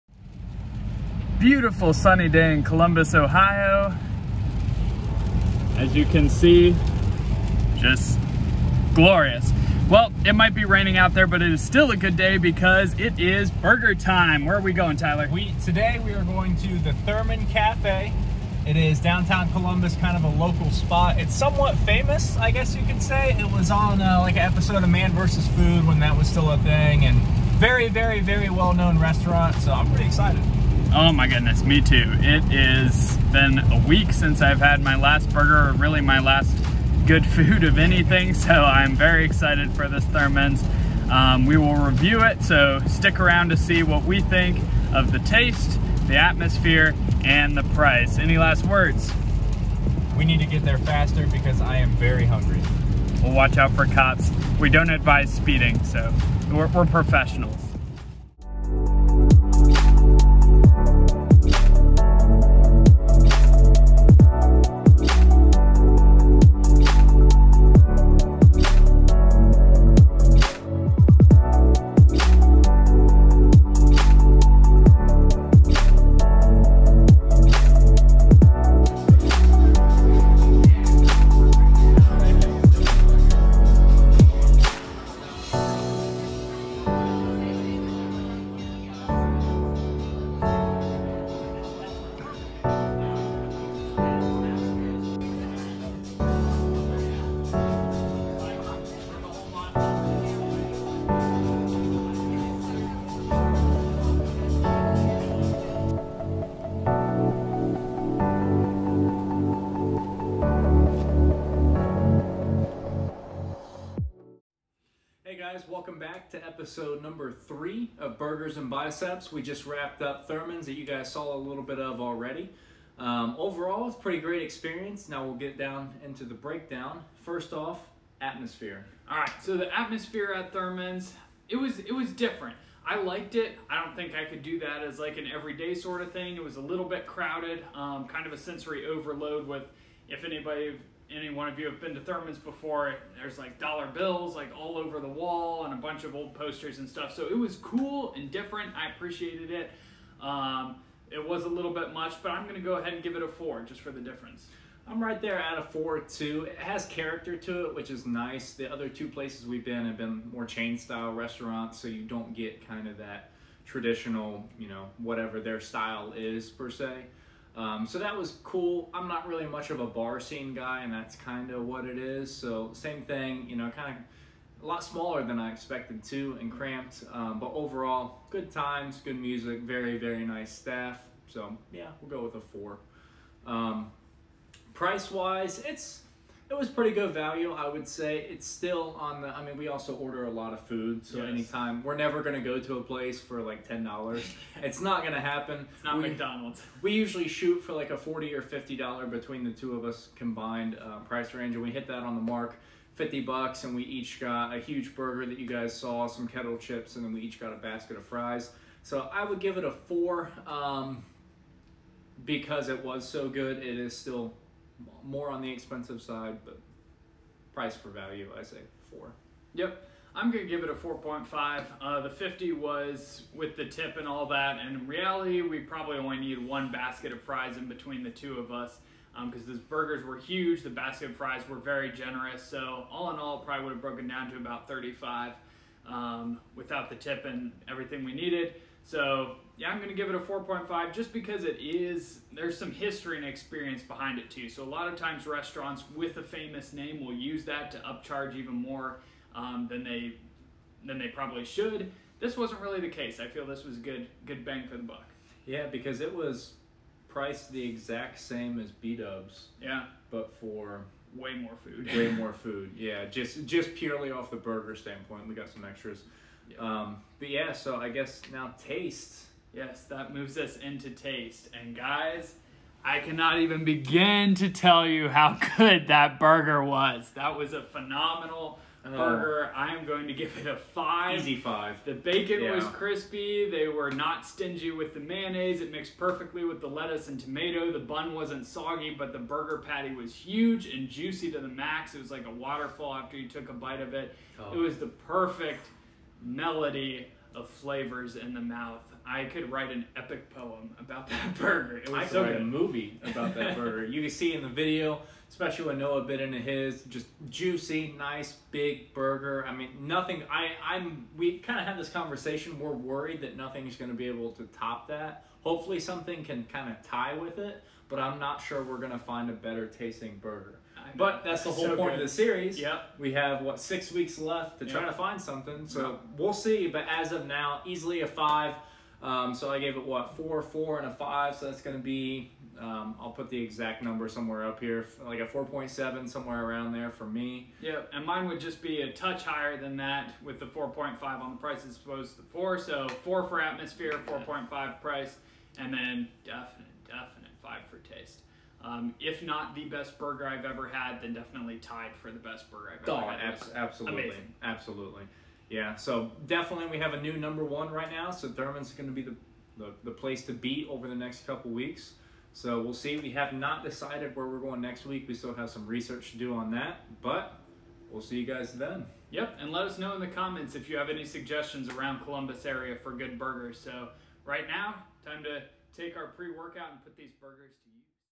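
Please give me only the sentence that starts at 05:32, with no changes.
Um, I'll put the exact number somewhere up here, like a four point seven somewhere around there for me.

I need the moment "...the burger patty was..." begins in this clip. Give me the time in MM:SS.
04:49.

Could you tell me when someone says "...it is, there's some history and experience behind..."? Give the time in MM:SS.
04:01.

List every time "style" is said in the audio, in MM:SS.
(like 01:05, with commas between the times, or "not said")
02:40, 02:45.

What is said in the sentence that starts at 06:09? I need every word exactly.
Yep, and let us know in the comments if you have any suggestions around Columbus area for good burgers.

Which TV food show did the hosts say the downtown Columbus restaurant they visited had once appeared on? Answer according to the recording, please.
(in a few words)
Man vs. Food.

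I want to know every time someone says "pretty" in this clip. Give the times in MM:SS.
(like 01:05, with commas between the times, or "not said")
00:29, 02:03, 03:06.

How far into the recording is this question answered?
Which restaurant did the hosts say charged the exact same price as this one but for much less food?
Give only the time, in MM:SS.
04:18.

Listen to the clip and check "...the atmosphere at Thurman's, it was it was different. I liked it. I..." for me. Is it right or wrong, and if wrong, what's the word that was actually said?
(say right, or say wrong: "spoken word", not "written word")
right.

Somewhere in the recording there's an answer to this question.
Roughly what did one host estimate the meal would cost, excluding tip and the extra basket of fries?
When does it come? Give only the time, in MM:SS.
03:54.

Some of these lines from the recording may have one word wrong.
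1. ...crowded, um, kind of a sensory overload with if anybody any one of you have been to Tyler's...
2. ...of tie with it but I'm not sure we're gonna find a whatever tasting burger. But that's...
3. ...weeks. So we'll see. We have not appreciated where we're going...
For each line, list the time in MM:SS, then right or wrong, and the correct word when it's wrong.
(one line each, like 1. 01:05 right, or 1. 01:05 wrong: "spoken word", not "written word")
1. 02:17 wrong: "Thurman", not "Tyler"
2. 05:16 wrong: "better", not "whatever"
3. 06:01 wrong: "decided", not "appreciated".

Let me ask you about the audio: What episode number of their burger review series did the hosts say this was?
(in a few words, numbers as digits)
3.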